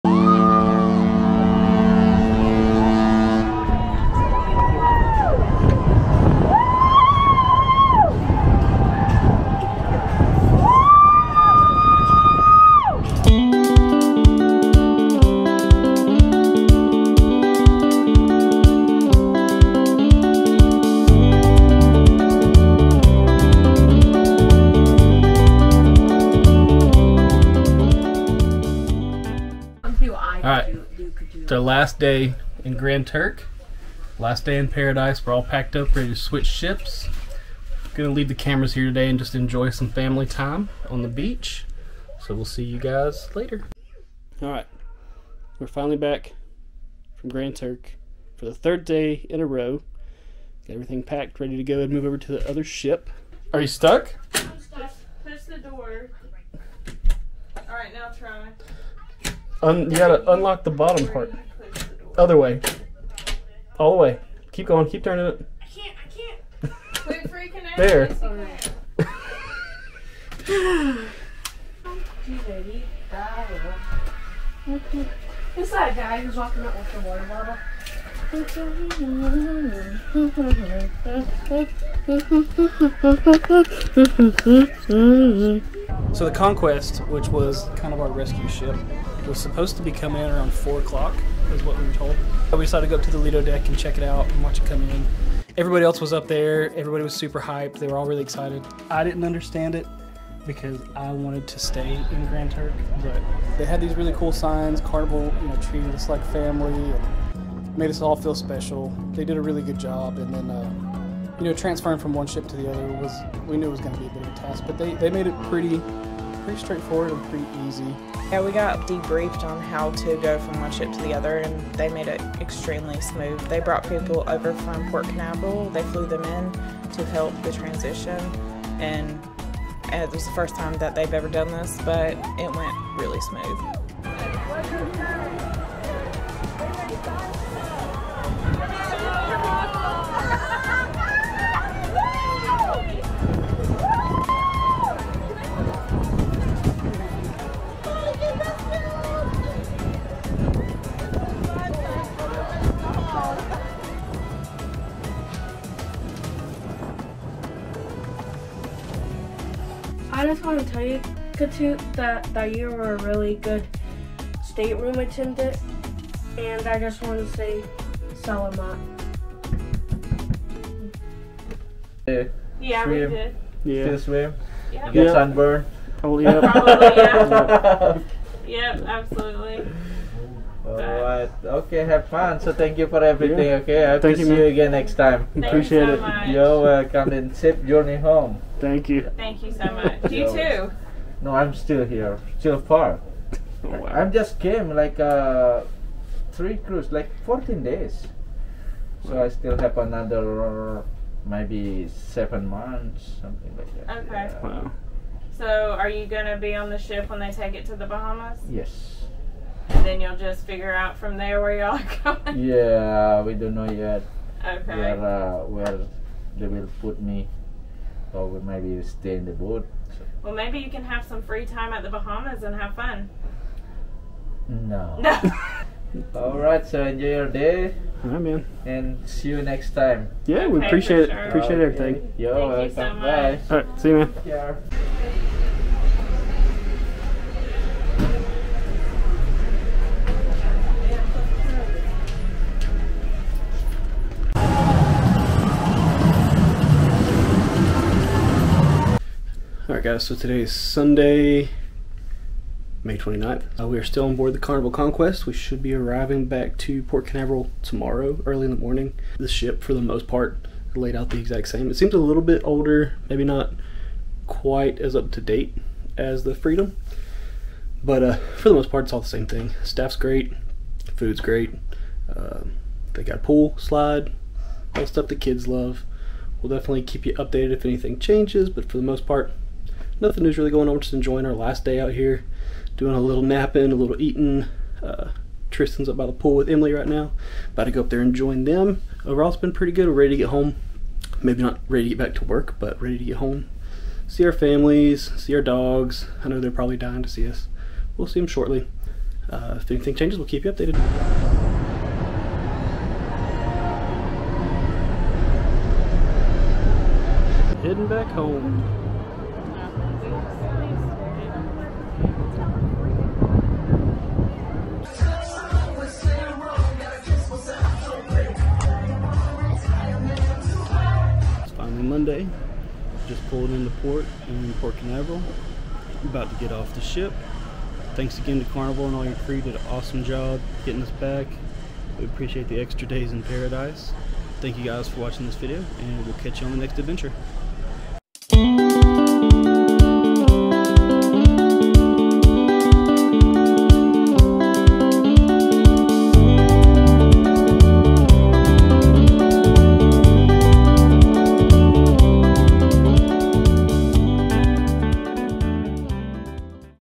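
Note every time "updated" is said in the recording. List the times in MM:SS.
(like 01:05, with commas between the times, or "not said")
04:37, 05:00.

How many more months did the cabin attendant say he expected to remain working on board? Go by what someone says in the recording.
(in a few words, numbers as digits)
7 months.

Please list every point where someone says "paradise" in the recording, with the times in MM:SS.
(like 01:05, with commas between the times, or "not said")
00:34, 05:33.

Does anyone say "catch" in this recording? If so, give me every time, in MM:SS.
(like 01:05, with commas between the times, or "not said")
05:36.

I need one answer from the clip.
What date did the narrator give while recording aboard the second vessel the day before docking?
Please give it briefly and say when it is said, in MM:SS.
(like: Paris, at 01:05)
Sunday, May 29th, at 04:10.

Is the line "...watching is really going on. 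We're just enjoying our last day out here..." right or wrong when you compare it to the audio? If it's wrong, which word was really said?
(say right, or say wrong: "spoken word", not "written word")
wrong: "nothing", not "watching".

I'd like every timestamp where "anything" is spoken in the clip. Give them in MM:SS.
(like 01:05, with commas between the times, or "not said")
04:37, 04:59.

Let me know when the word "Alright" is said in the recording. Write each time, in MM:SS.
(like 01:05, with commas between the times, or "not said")
00:44, 00:57, 03:00, 04:09.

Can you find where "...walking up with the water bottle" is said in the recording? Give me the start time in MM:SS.
01:16.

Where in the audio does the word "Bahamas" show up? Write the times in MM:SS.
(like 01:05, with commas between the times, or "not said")
03:27, 03:41.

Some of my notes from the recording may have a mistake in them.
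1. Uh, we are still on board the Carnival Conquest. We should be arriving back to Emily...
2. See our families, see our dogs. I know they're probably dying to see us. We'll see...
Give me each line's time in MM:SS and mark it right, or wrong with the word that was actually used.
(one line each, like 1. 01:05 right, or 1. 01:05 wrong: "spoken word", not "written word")
1. 04:13 wrong: "Port", not "Emily"
2. 04:54 right.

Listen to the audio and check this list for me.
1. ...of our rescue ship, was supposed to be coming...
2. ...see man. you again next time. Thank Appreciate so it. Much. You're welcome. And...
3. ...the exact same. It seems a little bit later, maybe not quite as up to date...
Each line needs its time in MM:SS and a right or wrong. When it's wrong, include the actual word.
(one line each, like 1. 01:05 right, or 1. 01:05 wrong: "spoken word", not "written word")
1. 01:27 right
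2. 03:04 right
3. 04:21 wrong: "older", not "later".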